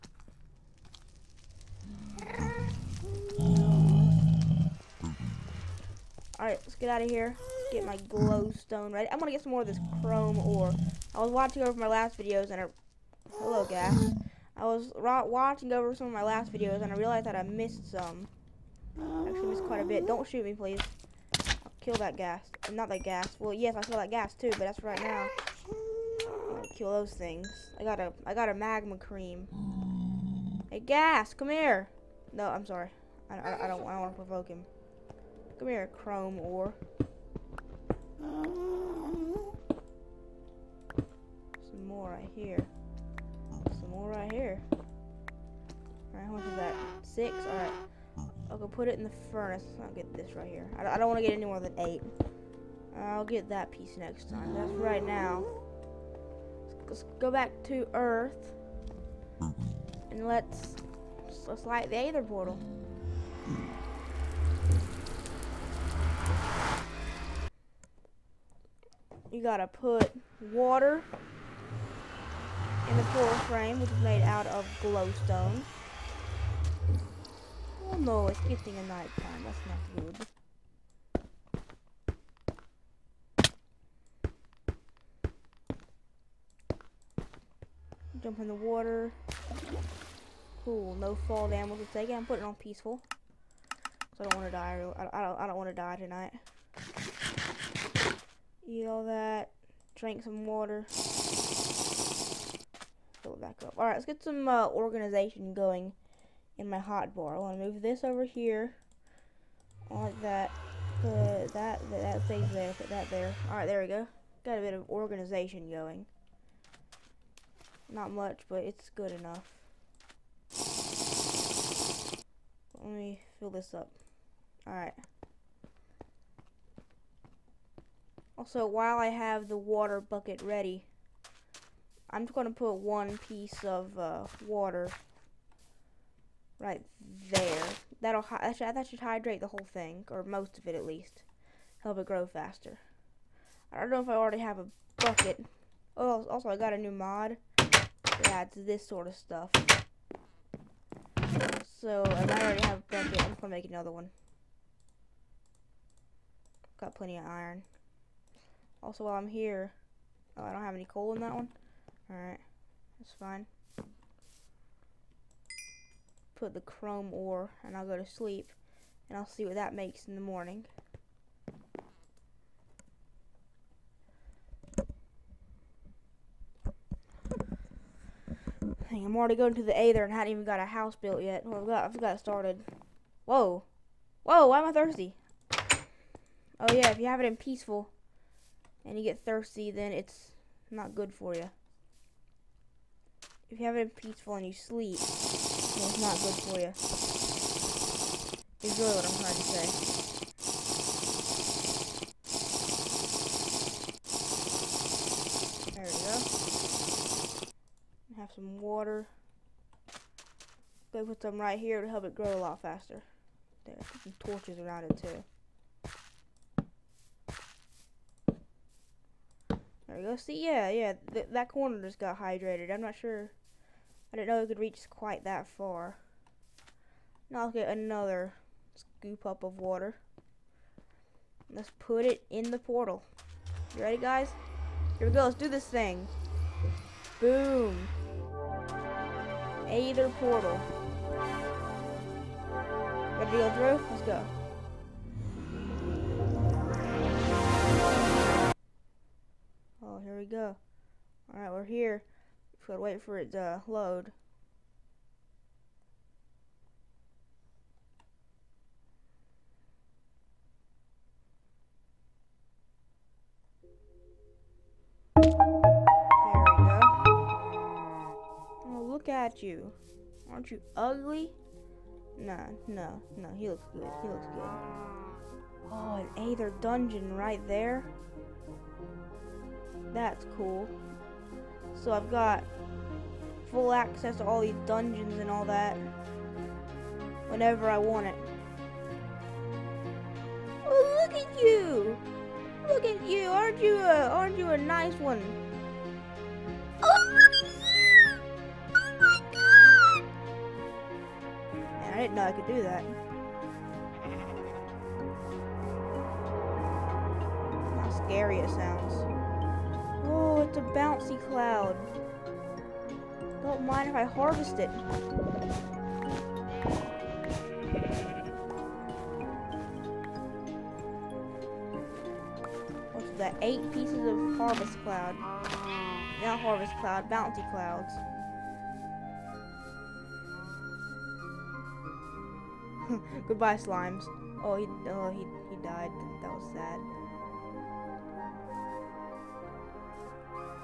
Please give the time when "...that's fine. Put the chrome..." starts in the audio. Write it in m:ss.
2:42.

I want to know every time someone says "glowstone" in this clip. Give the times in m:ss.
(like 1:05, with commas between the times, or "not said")
0:07, 1:14.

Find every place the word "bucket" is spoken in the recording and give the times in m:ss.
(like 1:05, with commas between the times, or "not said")
2:09, 2:24, 2:32.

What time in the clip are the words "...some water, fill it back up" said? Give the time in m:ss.
1:40.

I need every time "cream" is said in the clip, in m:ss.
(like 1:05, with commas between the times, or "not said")
0:28.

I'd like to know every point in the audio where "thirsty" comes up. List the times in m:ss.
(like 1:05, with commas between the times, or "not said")
3:04, 3:09.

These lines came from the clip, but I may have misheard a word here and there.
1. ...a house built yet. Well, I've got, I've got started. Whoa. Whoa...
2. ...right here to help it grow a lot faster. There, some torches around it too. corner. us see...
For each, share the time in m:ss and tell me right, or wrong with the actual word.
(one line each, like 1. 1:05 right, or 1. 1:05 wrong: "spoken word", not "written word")
1. 3:00 right
2. 3:31 right.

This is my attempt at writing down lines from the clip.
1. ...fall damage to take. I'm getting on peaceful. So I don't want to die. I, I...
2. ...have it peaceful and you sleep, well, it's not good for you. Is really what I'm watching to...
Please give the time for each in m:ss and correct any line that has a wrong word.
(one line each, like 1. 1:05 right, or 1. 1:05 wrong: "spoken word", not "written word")
1. 1:31 wrong: "putting", not "getting"
2. 3:13 wrong: "trying", not "watching".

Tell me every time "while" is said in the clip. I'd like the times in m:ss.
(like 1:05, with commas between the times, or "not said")
2:08, 2:39.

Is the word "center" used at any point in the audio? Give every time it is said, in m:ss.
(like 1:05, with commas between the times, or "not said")
not said.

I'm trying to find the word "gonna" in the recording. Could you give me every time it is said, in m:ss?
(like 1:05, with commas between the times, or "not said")
0:09.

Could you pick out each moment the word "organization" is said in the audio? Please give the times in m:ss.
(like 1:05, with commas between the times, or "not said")
1:44, 1:54.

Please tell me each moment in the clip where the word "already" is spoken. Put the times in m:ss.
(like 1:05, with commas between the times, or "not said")
2:24, 2:32, 2:59.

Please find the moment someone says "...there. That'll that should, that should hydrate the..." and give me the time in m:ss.
2:17.